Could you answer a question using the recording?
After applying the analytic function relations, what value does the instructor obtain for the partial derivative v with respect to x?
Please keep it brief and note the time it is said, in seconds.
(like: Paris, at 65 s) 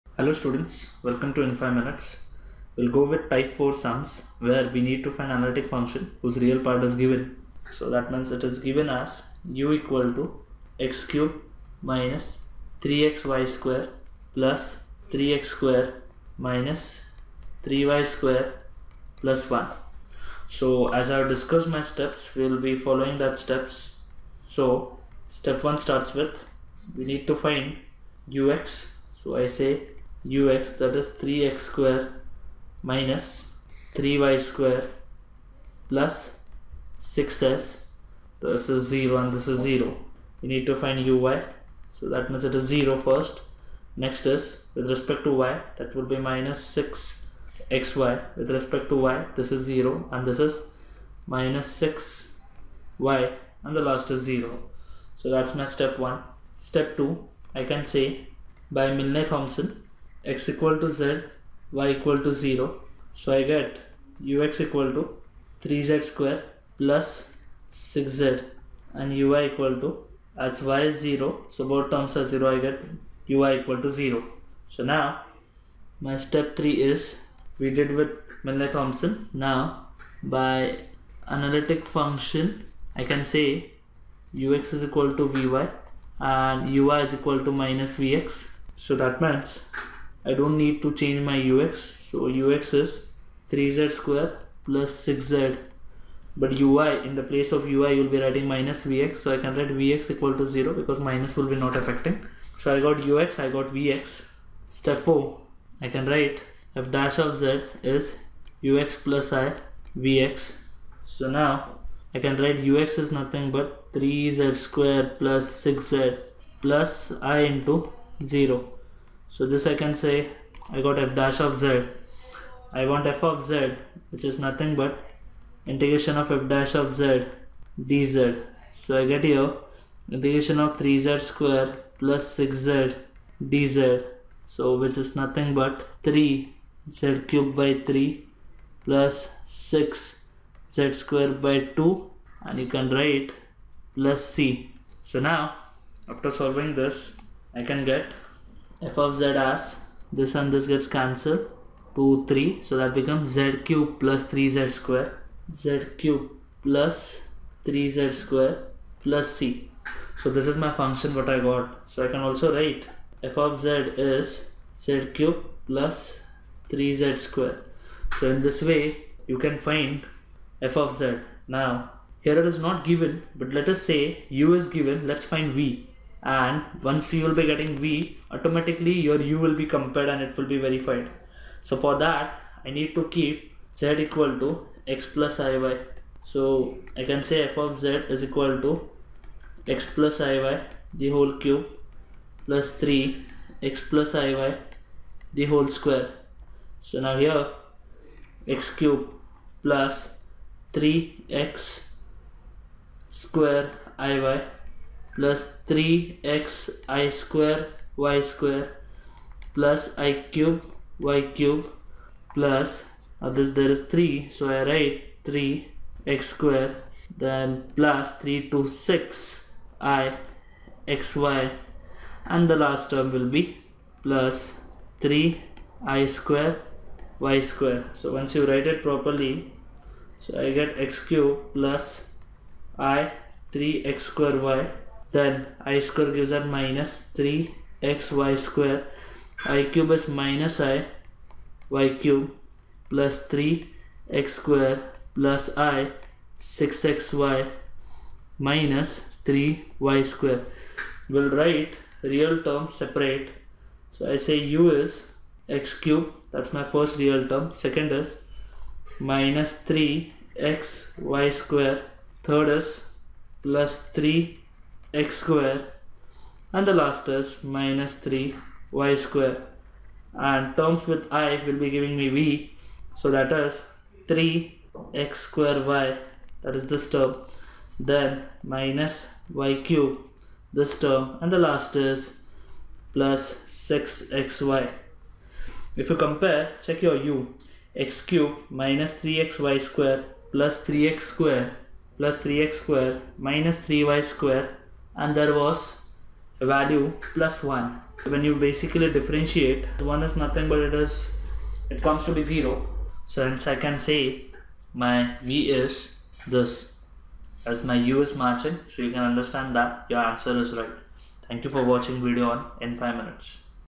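0, at 99 s.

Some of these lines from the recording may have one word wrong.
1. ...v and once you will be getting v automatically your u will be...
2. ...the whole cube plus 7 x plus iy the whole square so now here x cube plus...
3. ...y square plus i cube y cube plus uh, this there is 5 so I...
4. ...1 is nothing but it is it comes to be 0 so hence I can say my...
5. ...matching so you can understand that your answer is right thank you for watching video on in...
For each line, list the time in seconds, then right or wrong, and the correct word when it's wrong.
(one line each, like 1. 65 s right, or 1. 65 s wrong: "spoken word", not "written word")
1. 175 s right
2. 190 s wrong: "3", not "7"
3. 208 s wrong: "3", not "5"
4. 299 s right
5. 308 s right.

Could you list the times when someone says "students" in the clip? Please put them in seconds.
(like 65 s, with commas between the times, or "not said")
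0 s.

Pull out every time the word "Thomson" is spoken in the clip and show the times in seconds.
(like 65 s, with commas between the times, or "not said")
59 s, 78 s.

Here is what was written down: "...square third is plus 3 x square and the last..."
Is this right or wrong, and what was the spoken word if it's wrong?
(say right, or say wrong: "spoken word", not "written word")
right.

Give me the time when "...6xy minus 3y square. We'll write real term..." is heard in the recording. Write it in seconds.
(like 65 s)
246 s.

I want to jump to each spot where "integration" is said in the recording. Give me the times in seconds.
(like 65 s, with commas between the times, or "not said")
125 s, 130 s.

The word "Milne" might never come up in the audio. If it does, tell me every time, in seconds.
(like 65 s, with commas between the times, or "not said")
58 s, 78 s.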